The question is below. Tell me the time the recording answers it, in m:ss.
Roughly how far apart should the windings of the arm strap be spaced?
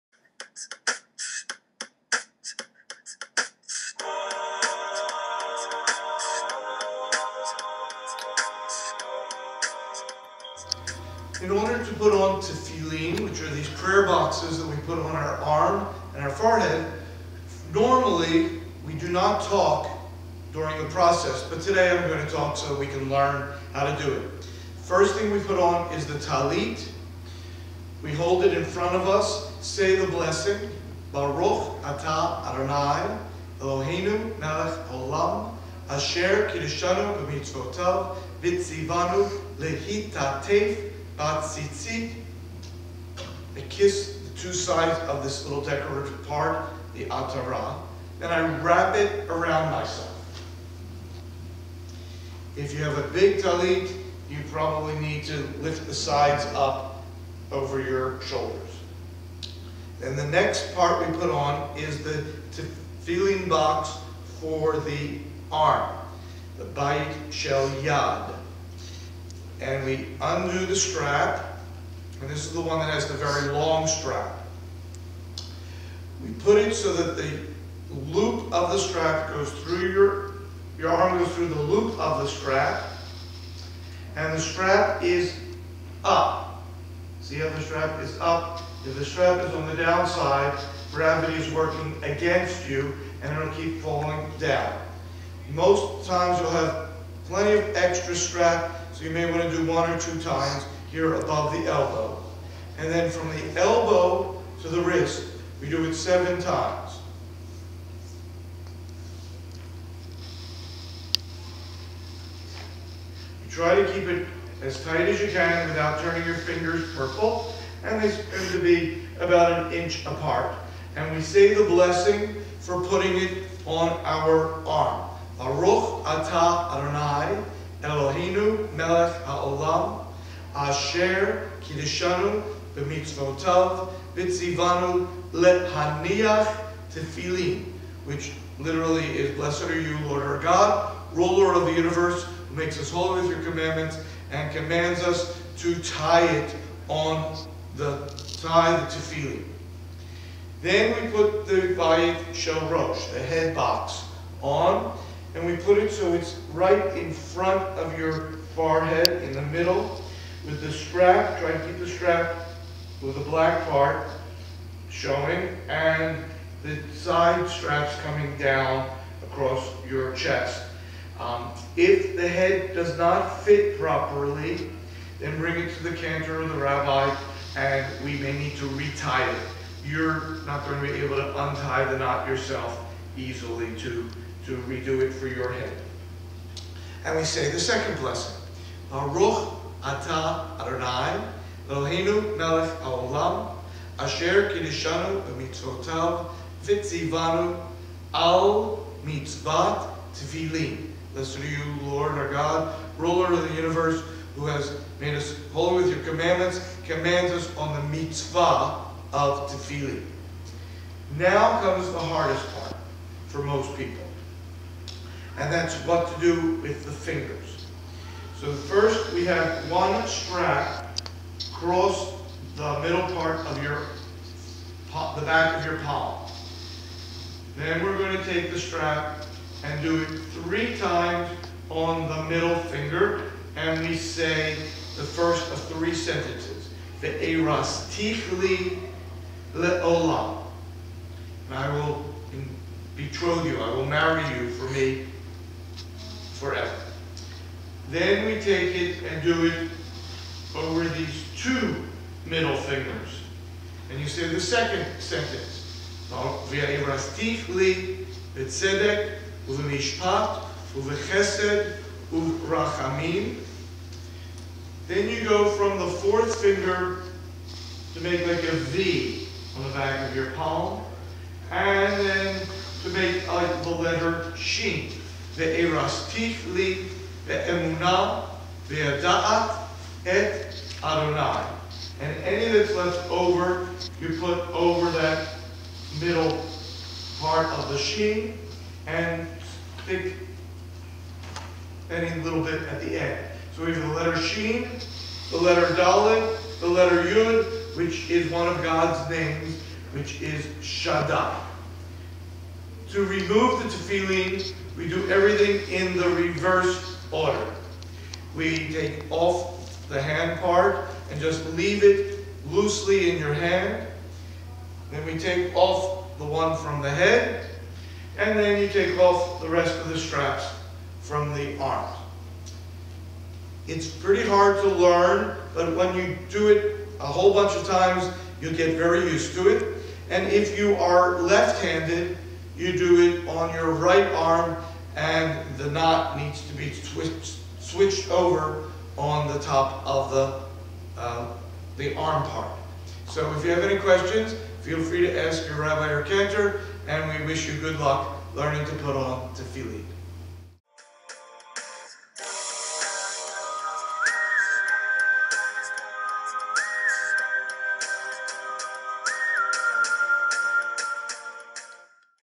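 1:59.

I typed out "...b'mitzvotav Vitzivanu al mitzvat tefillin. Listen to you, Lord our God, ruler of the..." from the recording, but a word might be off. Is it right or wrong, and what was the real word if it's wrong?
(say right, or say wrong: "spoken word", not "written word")
right.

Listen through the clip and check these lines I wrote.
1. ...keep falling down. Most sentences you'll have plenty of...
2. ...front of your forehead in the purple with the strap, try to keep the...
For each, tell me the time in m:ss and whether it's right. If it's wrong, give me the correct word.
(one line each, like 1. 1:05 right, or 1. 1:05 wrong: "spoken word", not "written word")
1. 1:33 wrong: "times", not "sentences"
2. 2:37 wrong: "middle", not "purple".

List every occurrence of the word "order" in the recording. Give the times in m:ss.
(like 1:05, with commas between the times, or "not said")
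0:11, 5:07.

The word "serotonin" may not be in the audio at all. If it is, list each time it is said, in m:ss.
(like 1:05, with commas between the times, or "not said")
not said.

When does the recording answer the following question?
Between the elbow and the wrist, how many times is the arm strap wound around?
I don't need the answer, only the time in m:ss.
1:45.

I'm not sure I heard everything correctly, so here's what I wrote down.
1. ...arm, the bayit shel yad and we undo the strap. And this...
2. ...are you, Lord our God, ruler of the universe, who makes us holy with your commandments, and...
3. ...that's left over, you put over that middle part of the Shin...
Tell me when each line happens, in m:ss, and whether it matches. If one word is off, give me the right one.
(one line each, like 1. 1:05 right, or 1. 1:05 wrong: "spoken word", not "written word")
1. 1:05 right
2. 2:19 right
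3. 4:42 right.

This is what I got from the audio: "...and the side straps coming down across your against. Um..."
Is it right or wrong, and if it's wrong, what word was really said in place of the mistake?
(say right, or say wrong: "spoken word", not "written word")
wrong: "chest", not "against".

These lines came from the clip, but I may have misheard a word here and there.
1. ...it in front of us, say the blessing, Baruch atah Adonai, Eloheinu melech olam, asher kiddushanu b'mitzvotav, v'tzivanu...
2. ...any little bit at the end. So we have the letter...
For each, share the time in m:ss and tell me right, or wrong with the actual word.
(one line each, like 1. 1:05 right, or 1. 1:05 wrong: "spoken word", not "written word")
1. 0:28 right
2. 4:51 right.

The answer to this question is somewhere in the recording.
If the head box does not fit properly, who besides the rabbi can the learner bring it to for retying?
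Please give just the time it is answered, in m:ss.
2:55.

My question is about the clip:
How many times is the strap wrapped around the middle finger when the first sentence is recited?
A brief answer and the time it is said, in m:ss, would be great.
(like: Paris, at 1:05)
3, at 3:50.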